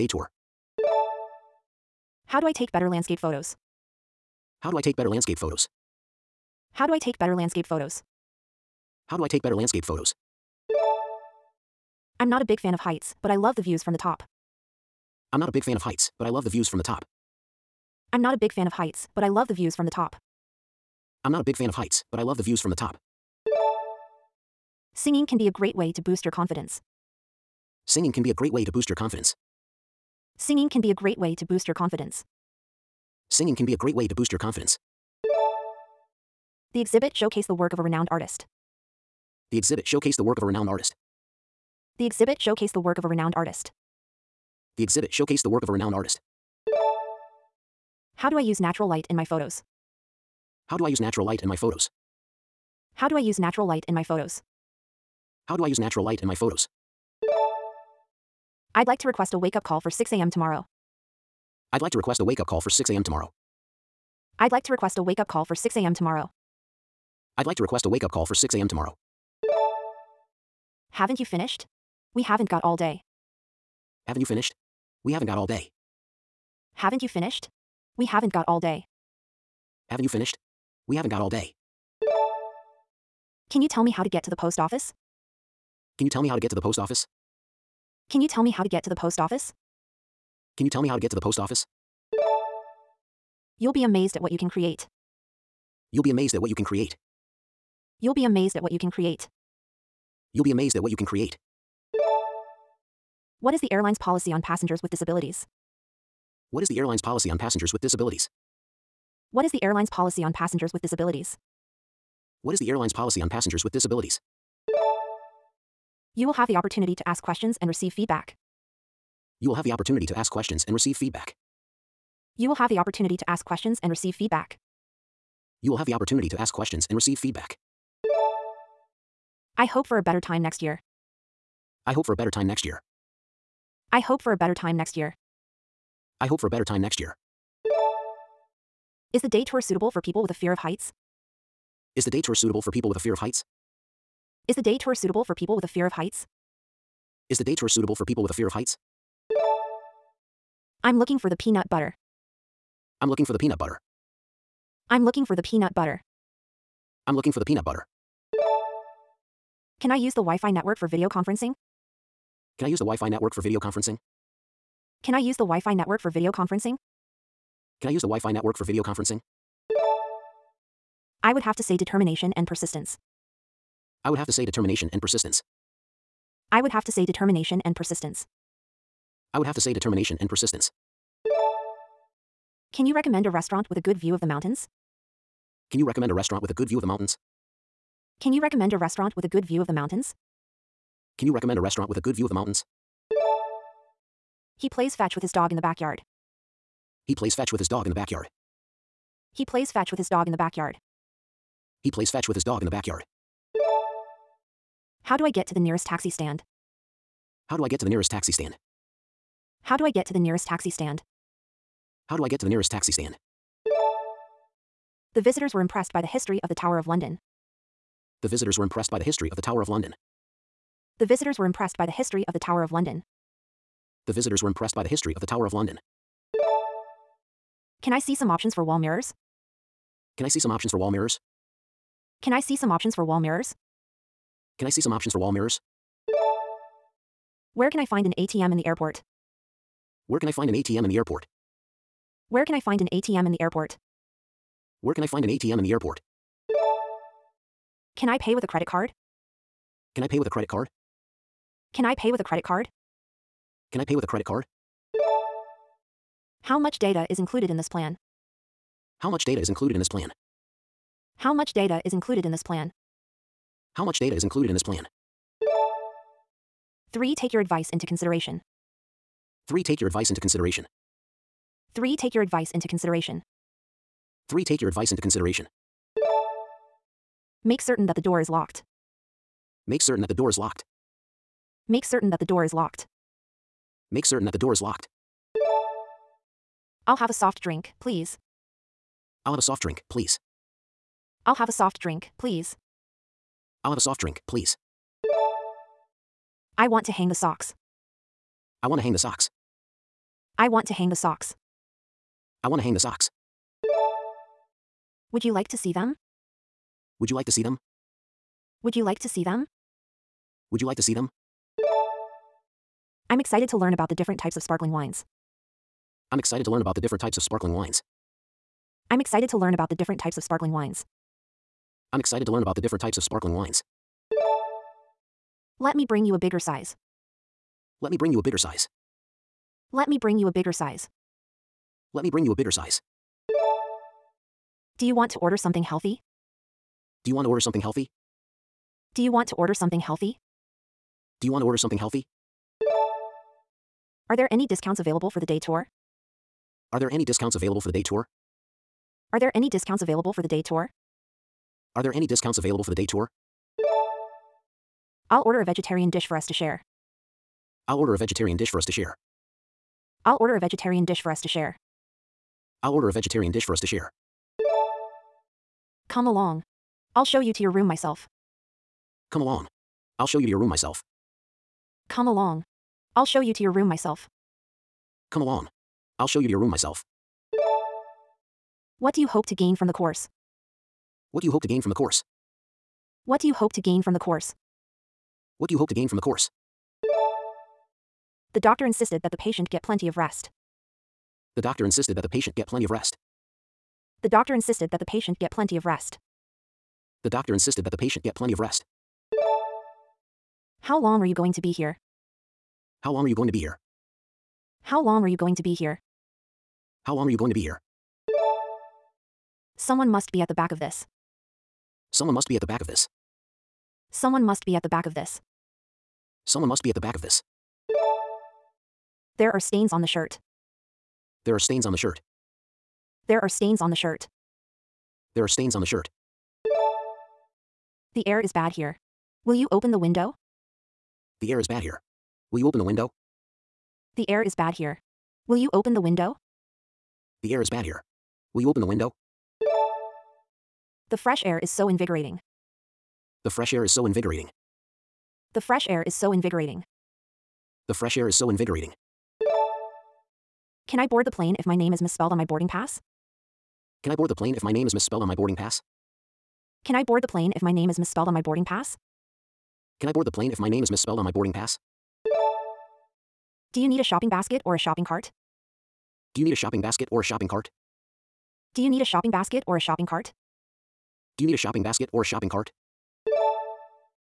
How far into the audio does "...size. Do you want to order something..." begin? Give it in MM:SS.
05:32.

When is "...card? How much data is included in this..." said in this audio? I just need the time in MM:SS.
04:14.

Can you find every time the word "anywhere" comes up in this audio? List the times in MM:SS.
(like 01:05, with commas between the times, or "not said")
not said.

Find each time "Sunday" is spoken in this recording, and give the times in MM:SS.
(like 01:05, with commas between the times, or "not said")
not said.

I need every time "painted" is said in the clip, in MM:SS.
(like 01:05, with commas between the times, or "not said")
not said.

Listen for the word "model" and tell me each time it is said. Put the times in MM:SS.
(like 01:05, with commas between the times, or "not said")
not said.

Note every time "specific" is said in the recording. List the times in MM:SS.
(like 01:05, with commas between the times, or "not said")
not said.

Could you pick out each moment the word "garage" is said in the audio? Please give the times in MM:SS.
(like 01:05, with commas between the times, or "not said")
not said.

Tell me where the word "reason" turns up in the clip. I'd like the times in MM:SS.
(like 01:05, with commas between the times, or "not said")
not said.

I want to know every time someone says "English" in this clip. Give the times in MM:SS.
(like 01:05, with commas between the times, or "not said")
not said.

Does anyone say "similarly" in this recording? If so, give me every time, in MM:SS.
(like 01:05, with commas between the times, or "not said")
not said.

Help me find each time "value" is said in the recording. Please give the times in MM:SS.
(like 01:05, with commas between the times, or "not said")
not said.